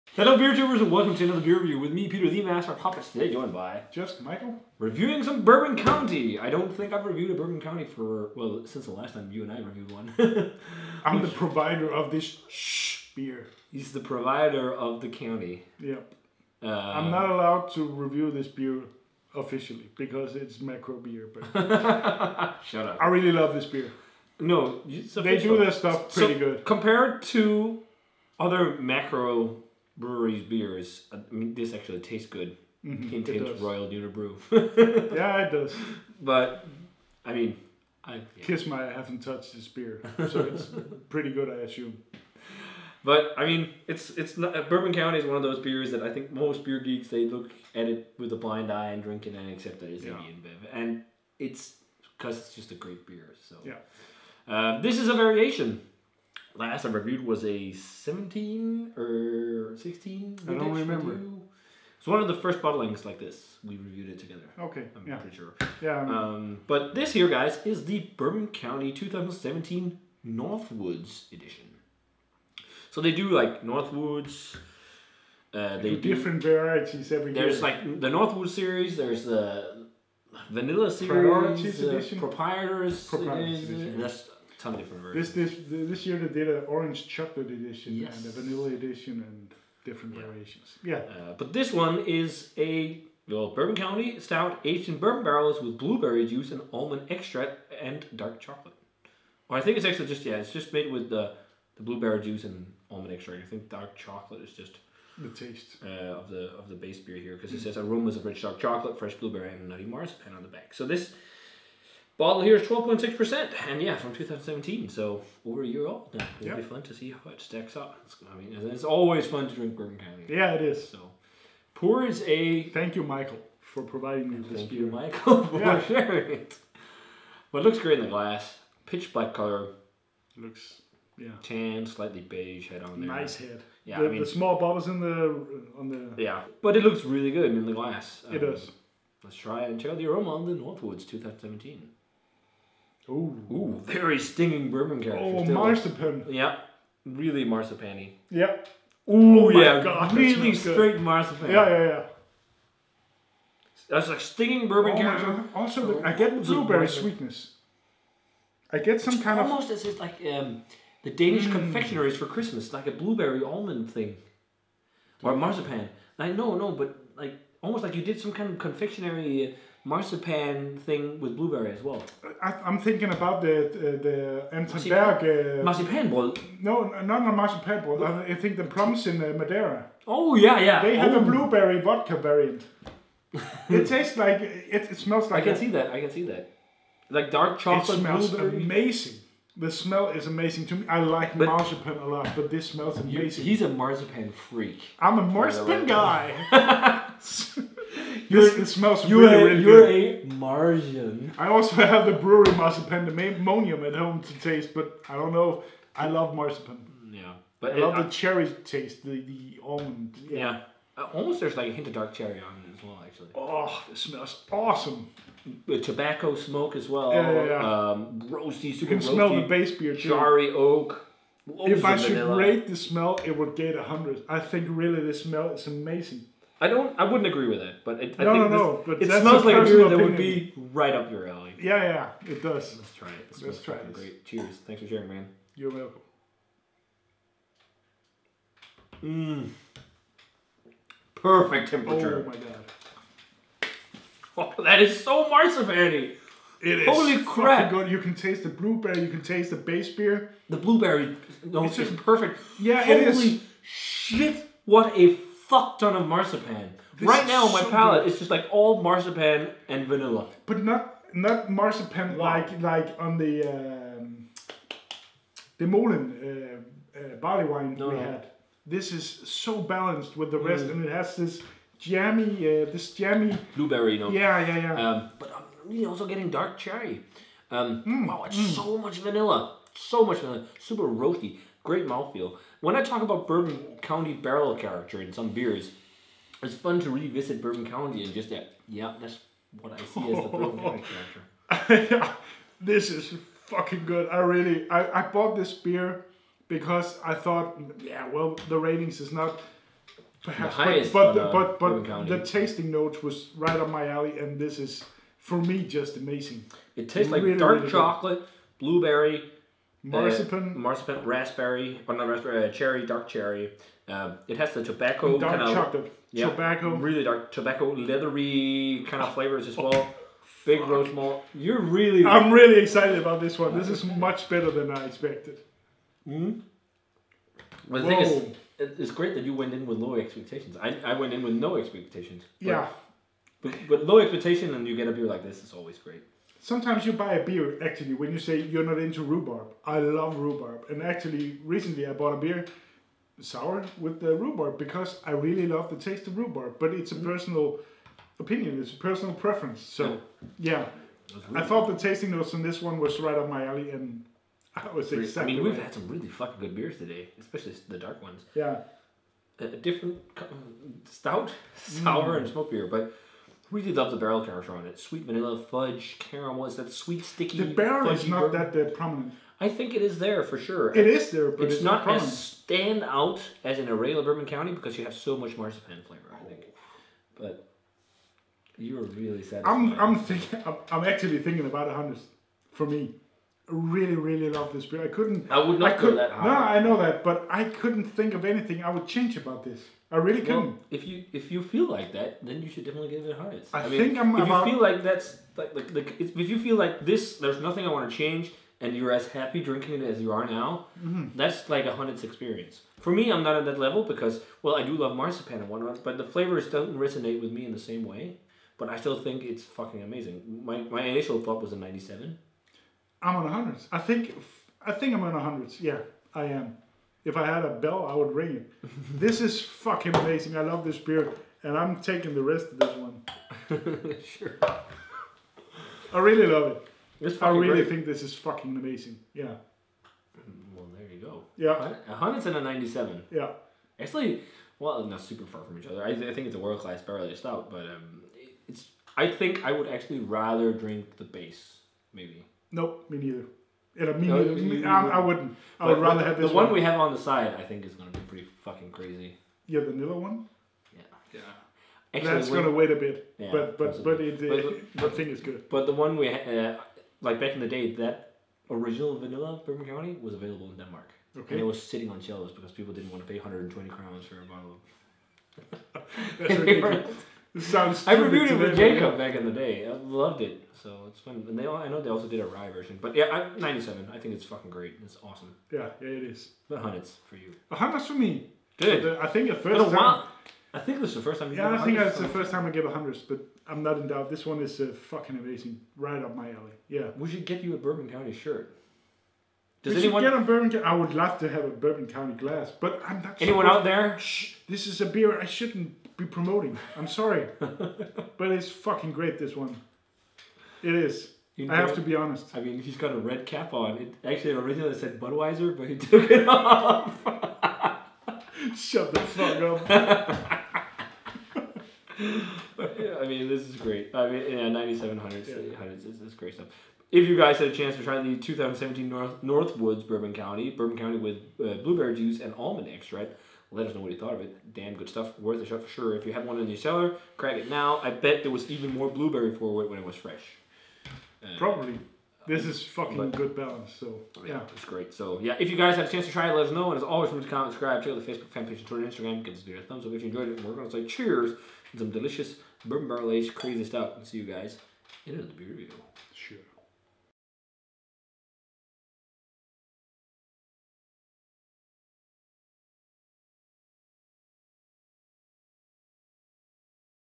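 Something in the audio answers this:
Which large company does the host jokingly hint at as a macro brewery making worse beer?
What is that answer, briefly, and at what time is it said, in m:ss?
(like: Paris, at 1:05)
Royal Unibrew, at 0:33.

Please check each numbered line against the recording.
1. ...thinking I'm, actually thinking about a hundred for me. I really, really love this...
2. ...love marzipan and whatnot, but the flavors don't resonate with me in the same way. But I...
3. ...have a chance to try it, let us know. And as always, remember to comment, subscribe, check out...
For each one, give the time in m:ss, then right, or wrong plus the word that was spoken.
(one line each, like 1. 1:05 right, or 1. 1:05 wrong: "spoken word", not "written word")
1. 6:19 right
2. 6:44 right
3. 8:55 right.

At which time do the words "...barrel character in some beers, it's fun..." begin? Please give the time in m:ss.
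4:44.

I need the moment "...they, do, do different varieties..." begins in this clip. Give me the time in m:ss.
1:15.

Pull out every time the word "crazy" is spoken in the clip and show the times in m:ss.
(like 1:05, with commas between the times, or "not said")
7:28, 9:03.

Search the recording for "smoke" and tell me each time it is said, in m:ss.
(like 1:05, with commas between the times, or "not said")
3:36, 6:02.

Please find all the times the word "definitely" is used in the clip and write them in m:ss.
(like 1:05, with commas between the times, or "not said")
6:32.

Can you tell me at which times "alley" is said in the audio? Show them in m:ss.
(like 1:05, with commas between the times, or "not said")
3:51, 5:03, 5:53, 8:06.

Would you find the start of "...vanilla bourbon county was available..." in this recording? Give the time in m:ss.
7:38.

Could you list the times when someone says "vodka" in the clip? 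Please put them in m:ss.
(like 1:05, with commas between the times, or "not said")
3:01.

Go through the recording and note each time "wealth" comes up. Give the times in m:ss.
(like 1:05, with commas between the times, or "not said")
not said.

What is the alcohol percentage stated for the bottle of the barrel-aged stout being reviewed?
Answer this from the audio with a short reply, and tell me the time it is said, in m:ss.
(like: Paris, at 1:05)
12.6%, at 1:52.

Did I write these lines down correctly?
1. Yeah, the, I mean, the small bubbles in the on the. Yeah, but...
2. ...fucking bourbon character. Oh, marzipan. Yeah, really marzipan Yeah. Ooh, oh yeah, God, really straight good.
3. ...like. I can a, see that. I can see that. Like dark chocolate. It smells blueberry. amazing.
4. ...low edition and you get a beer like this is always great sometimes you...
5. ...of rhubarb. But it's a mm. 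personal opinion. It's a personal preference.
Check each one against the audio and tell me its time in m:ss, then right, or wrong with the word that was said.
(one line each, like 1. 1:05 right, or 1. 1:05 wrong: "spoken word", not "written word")
1. 2:13 right
2. 2:24 wrong: "stinging", not "fucking"
3. 3:05 right
4. 5:33 wrong: "expectation", not "edition"
5. 5:46 right.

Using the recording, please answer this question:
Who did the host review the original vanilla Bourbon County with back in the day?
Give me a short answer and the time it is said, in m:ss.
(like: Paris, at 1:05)
Jacob, at 7:48.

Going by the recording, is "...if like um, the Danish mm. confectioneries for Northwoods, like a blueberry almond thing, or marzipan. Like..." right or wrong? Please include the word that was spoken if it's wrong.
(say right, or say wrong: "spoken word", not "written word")
wrong: "Christmas", not "Northwoods".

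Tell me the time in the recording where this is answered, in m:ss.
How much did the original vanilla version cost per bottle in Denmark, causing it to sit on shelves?
7:43.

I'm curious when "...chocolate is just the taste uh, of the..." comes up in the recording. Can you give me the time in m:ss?
1:43.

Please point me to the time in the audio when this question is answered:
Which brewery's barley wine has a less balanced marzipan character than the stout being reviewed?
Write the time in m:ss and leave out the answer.
4:25.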